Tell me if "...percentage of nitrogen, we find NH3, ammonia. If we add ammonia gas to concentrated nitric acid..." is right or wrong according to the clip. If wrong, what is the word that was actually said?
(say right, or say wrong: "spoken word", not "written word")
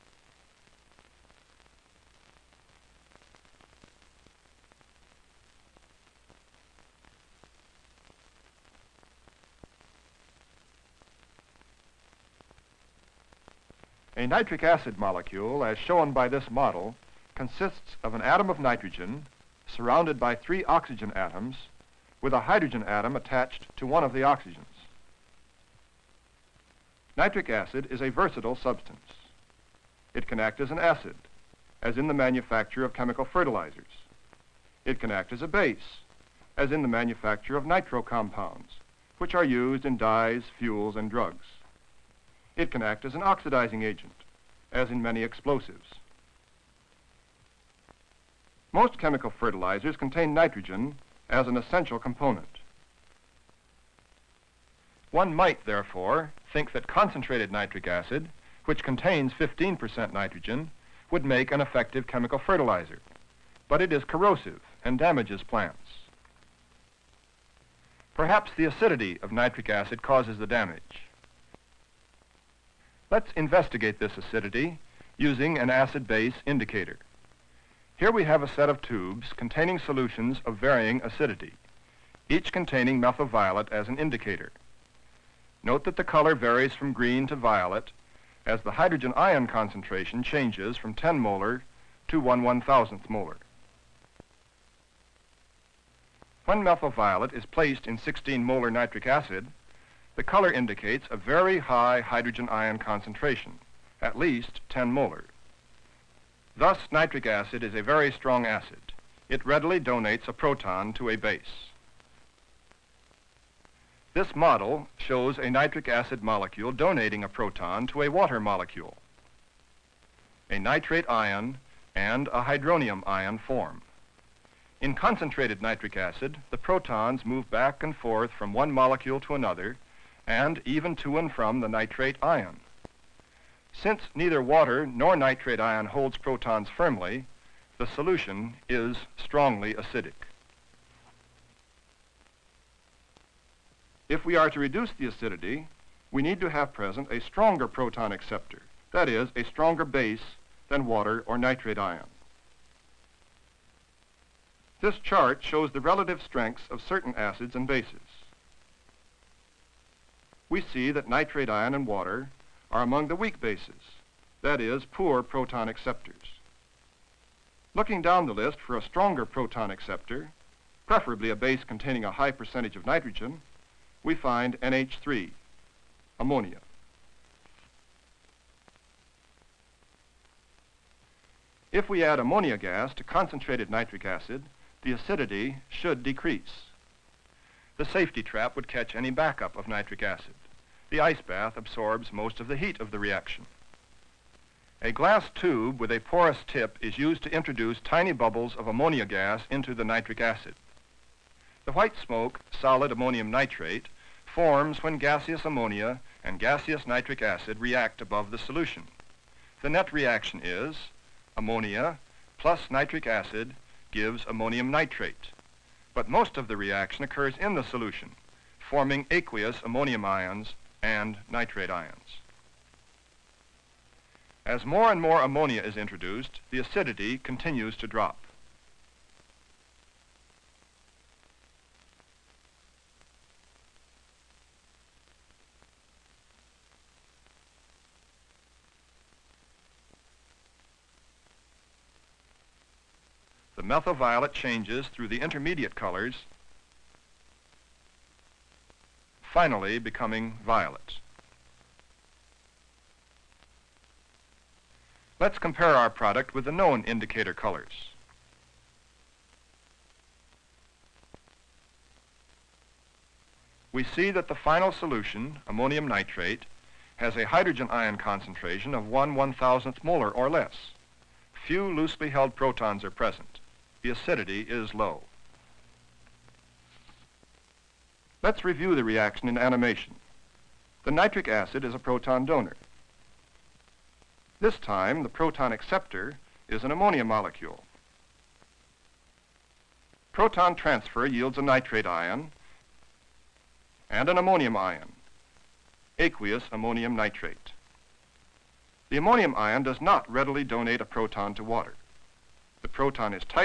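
right.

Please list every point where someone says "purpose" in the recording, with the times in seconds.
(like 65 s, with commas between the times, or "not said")
not said.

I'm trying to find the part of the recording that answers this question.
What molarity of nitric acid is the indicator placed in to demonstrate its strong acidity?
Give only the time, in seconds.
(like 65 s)
97 s.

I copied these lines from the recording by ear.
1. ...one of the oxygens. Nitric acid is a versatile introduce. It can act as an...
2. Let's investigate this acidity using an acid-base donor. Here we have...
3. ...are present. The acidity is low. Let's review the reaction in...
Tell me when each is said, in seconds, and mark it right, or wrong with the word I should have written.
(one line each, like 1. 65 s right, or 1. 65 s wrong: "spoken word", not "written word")
1. 23 s wrong: "substance", not "introduce"
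2. 73 s wrong: "indicator", not "donor"
3. 272 s right.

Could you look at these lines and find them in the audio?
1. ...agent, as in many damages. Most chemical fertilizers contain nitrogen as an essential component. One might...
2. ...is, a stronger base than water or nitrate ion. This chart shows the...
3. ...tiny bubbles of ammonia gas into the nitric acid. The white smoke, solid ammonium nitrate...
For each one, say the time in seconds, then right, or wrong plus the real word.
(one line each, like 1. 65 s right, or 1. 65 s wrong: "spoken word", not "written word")
1. 43 s wrong: "explosives", not "damages"
2. 149 s right
3. 197 s right.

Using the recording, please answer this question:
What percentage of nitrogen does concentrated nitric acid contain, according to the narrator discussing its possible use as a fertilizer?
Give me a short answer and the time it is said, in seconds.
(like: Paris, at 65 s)
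15%, at 59 s.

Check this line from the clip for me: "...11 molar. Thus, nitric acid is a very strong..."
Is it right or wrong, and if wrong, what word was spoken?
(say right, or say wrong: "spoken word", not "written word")
wrong: "10", not "11".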